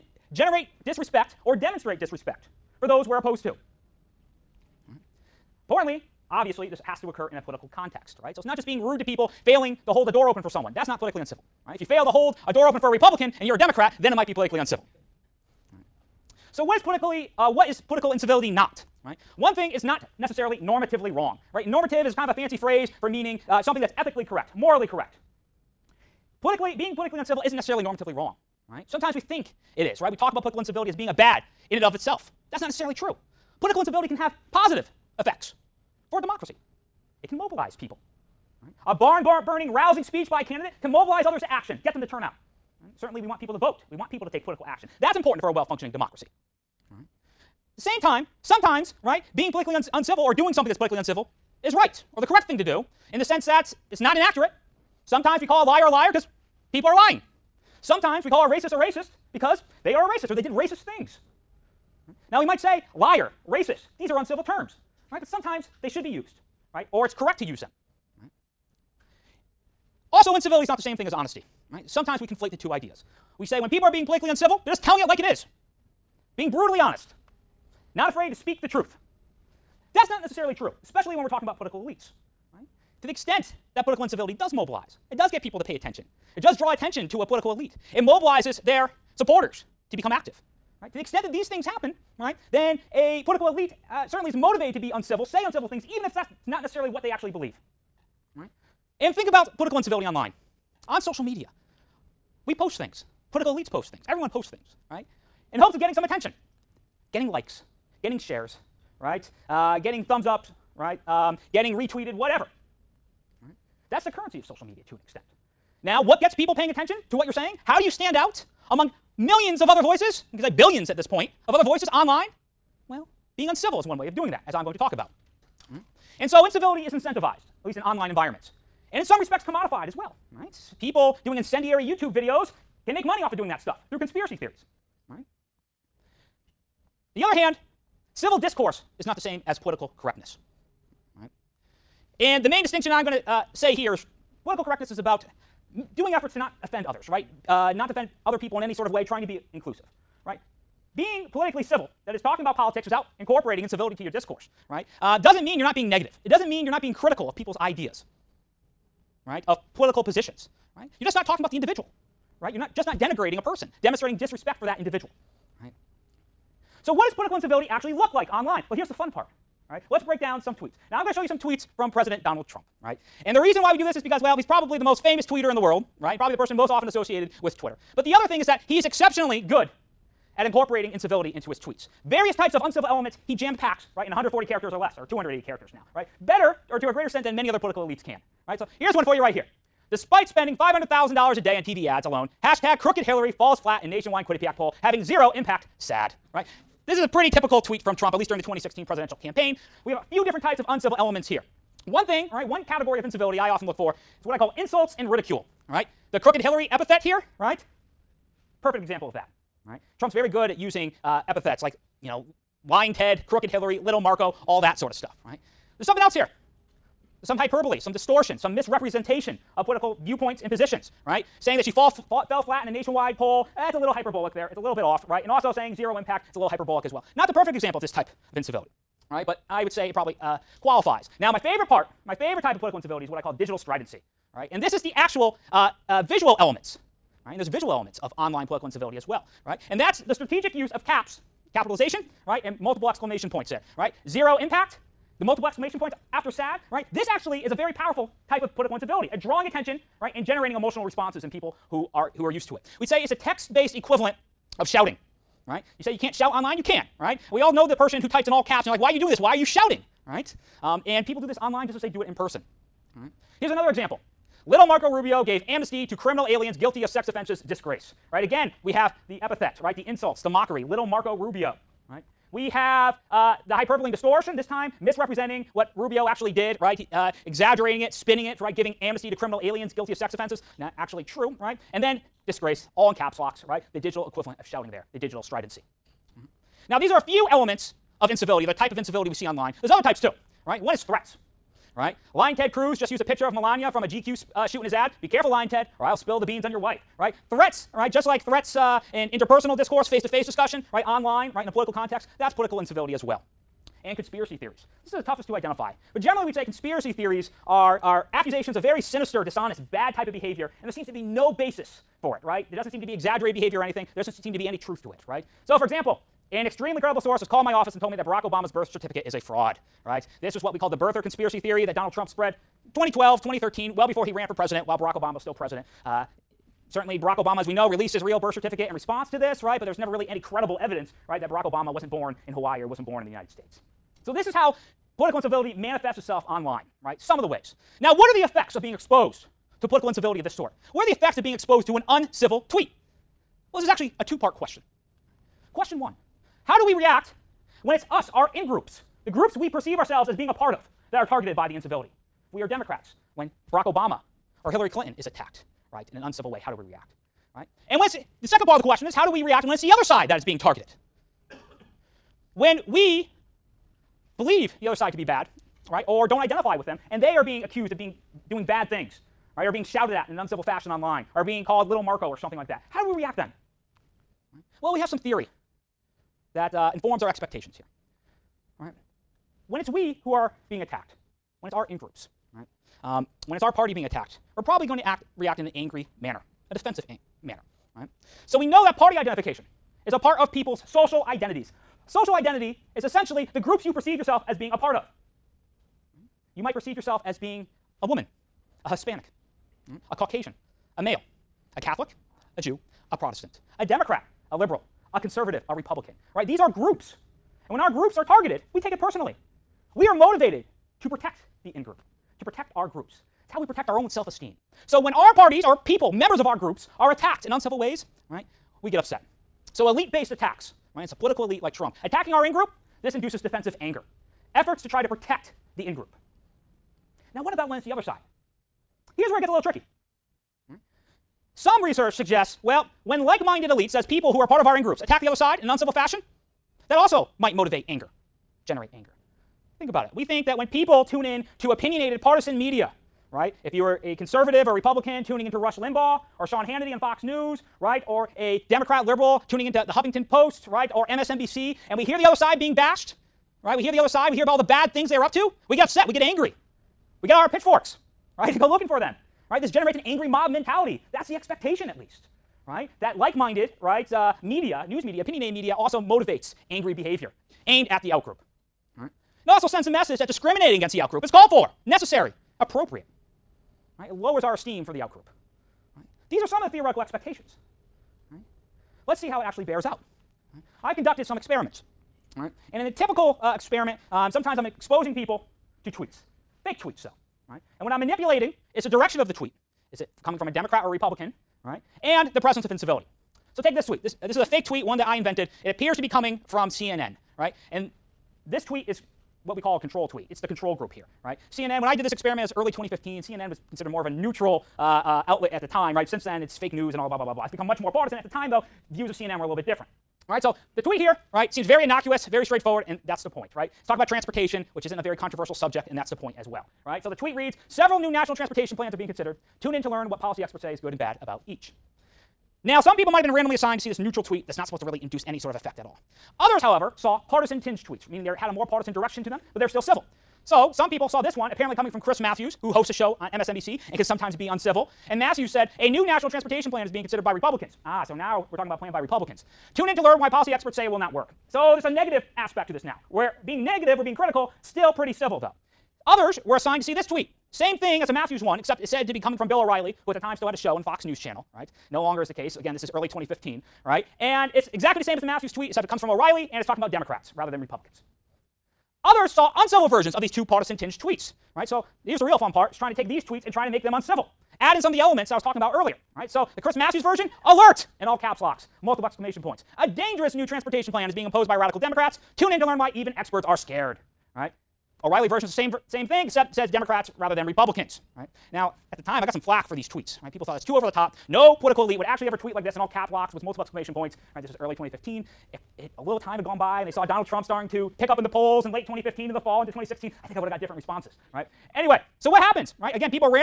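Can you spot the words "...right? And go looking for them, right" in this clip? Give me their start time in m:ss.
7:38.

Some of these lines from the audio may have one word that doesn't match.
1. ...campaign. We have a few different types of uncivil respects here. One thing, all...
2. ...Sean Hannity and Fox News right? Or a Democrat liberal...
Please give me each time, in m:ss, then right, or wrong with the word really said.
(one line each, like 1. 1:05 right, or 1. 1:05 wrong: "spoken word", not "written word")
1. 3:19 wrong: "elements", not "respects"
2. 7:26 right.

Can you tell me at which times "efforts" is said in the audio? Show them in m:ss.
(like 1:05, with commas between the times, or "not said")
2:26, 7:04.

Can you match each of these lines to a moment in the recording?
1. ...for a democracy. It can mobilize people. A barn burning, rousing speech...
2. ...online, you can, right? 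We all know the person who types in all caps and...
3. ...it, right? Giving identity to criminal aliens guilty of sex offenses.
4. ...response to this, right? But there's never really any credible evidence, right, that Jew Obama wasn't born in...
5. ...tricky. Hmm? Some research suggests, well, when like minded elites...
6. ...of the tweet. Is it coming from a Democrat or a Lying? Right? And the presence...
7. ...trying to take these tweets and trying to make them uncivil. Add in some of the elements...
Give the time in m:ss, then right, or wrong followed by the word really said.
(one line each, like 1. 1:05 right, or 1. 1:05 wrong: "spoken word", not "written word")
1. 0:36 right
2. 4:16 right
3. 4:38 wrong: "amnesty", not "identity"
4. 5:28 wrong: "Barack", not "Jew"
5. 7:09 right
6. 8:08 wrong: "Republican", not "Lying"
7. 9:22 right.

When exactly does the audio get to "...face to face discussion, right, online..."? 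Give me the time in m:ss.
4:59.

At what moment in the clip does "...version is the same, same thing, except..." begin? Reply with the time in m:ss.
9:35.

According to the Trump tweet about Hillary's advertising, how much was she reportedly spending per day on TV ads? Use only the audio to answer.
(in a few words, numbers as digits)
$500,000.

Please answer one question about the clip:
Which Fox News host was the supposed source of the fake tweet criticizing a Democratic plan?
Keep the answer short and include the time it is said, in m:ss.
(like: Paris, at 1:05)
Bill O'Reilly, at 9:09.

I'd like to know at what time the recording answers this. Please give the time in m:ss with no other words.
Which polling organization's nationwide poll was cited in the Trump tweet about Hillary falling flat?
3:14.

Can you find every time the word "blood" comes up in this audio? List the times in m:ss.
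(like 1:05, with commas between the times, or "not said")
not said.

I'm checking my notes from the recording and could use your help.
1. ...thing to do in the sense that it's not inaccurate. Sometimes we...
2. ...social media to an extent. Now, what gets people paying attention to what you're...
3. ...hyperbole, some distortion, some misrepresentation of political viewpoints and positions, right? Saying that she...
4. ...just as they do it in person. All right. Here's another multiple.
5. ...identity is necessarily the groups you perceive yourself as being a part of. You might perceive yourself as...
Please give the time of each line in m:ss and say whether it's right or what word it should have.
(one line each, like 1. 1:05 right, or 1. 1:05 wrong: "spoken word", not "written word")
1. 0:52 right
2. 1:54 right
3. 3:37 right
4. 4:21 wrong: "example", not "multiple"
5. 6:32 wrong: "essentially", not "necessarily".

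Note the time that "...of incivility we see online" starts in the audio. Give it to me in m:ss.
4:48.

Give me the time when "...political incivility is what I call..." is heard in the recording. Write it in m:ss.
3:52.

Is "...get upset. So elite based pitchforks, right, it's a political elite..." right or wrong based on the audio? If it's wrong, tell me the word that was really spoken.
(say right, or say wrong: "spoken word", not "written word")
wrong: "attacks", not "pitchforks".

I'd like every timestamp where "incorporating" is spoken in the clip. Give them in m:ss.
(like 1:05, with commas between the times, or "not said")
2:33, 3:00.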